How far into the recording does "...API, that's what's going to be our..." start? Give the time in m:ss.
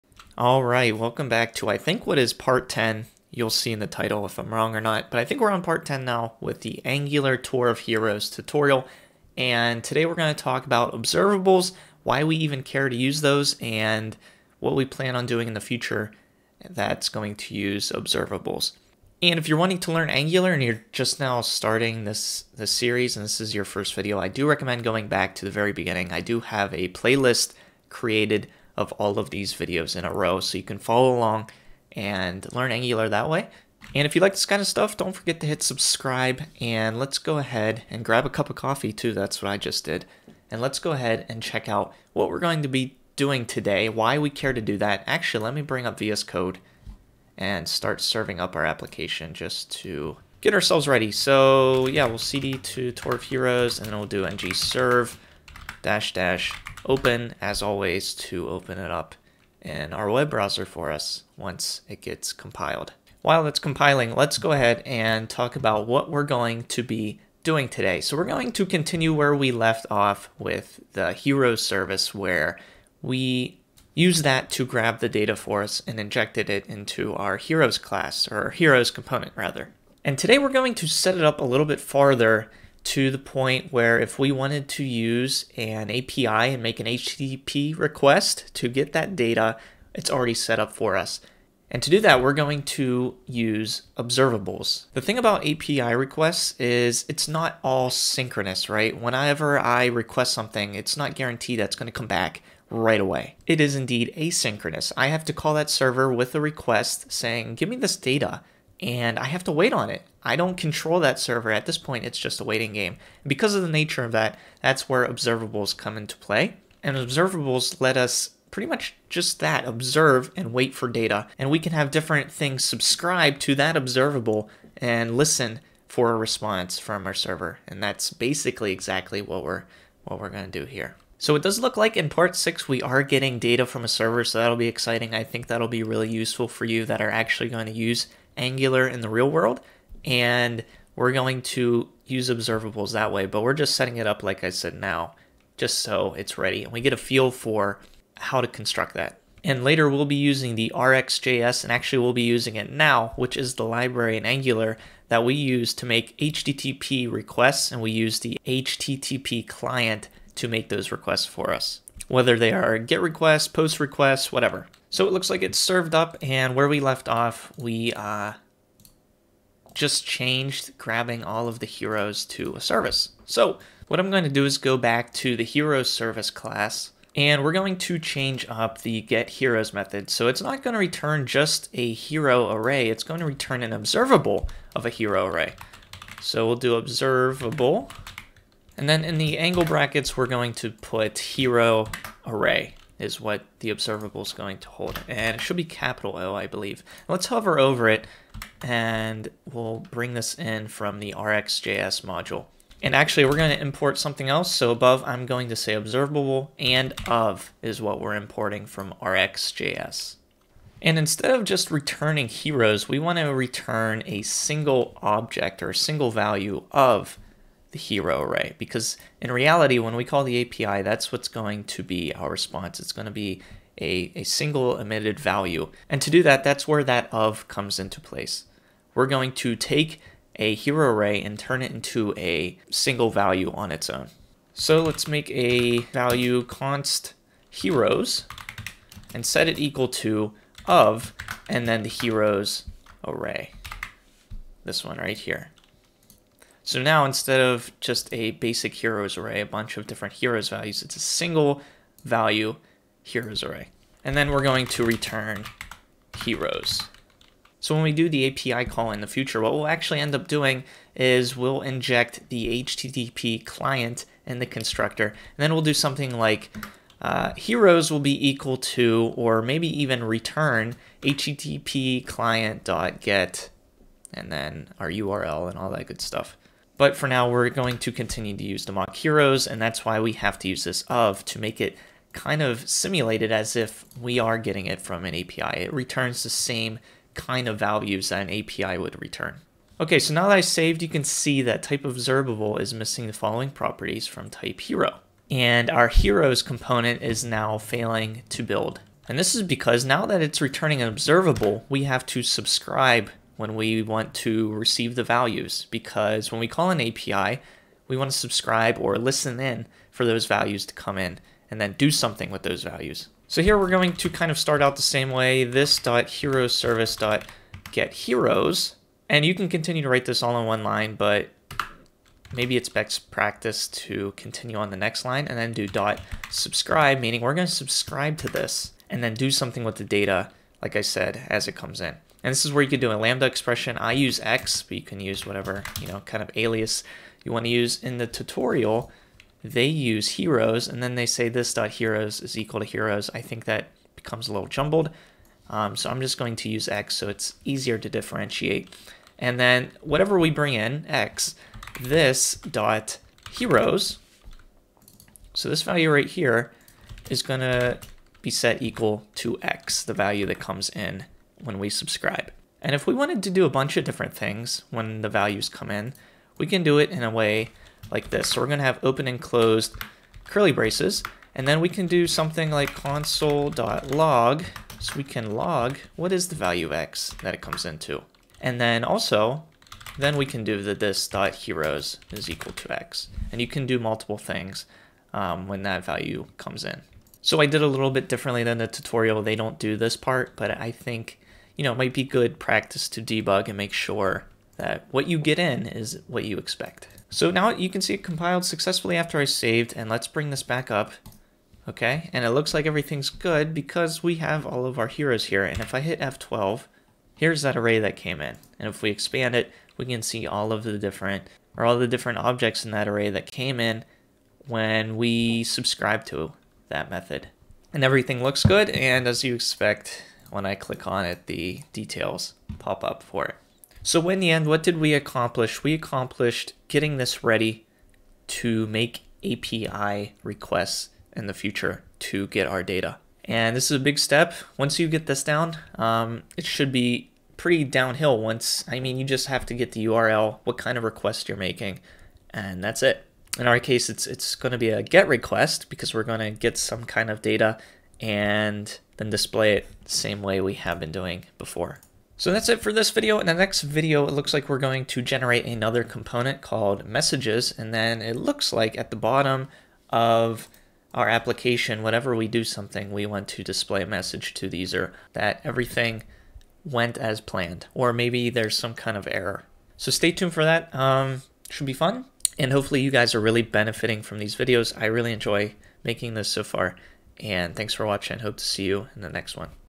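3:40.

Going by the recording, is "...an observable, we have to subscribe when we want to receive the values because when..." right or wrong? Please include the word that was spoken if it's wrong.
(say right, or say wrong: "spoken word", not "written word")
right.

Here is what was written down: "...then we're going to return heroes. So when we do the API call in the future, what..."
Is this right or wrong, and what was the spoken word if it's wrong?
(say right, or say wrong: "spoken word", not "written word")
right.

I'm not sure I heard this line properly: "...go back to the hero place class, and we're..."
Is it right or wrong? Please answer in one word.
wrong.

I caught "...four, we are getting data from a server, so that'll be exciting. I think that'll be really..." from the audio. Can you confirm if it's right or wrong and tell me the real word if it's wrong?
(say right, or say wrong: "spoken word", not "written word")
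wrong: "six", not "four".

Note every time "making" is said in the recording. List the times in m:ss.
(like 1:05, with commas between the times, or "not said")
7:21, 7:55.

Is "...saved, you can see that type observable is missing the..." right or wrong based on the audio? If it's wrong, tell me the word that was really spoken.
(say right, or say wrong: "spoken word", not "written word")
right.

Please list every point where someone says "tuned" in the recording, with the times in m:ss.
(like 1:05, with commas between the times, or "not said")
7:50.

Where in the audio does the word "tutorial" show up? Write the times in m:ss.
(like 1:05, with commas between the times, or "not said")
0:08, 5:38, 6:28.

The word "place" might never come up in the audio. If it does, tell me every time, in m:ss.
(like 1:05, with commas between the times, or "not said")
3:48.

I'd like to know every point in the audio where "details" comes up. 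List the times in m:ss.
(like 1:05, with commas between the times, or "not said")
7:01.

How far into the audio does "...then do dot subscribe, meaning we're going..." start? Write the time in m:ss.
5:25.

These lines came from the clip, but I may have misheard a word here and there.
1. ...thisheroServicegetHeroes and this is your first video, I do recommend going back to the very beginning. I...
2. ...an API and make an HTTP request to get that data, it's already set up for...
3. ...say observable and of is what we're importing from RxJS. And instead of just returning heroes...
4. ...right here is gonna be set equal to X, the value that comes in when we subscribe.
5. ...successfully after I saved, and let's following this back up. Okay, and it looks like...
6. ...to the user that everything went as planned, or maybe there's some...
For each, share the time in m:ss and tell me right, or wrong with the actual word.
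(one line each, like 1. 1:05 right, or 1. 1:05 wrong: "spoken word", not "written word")
1. 0:22 wrong: "series", not "thisheroServicegetHeroes"
2. 1:25 right
3. 3:25 right
4. 5:55 right
5. 6:38 wrong: "bring", not "following"
6. 7:44 right.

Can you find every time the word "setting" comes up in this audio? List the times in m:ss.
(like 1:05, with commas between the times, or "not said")
2:23.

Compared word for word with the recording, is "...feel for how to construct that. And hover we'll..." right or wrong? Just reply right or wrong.
wrong.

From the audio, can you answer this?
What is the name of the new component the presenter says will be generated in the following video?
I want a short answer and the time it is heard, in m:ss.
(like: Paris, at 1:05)
messages, at 7:36.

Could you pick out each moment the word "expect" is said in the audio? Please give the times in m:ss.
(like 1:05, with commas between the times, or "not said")
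6:36, 6:59.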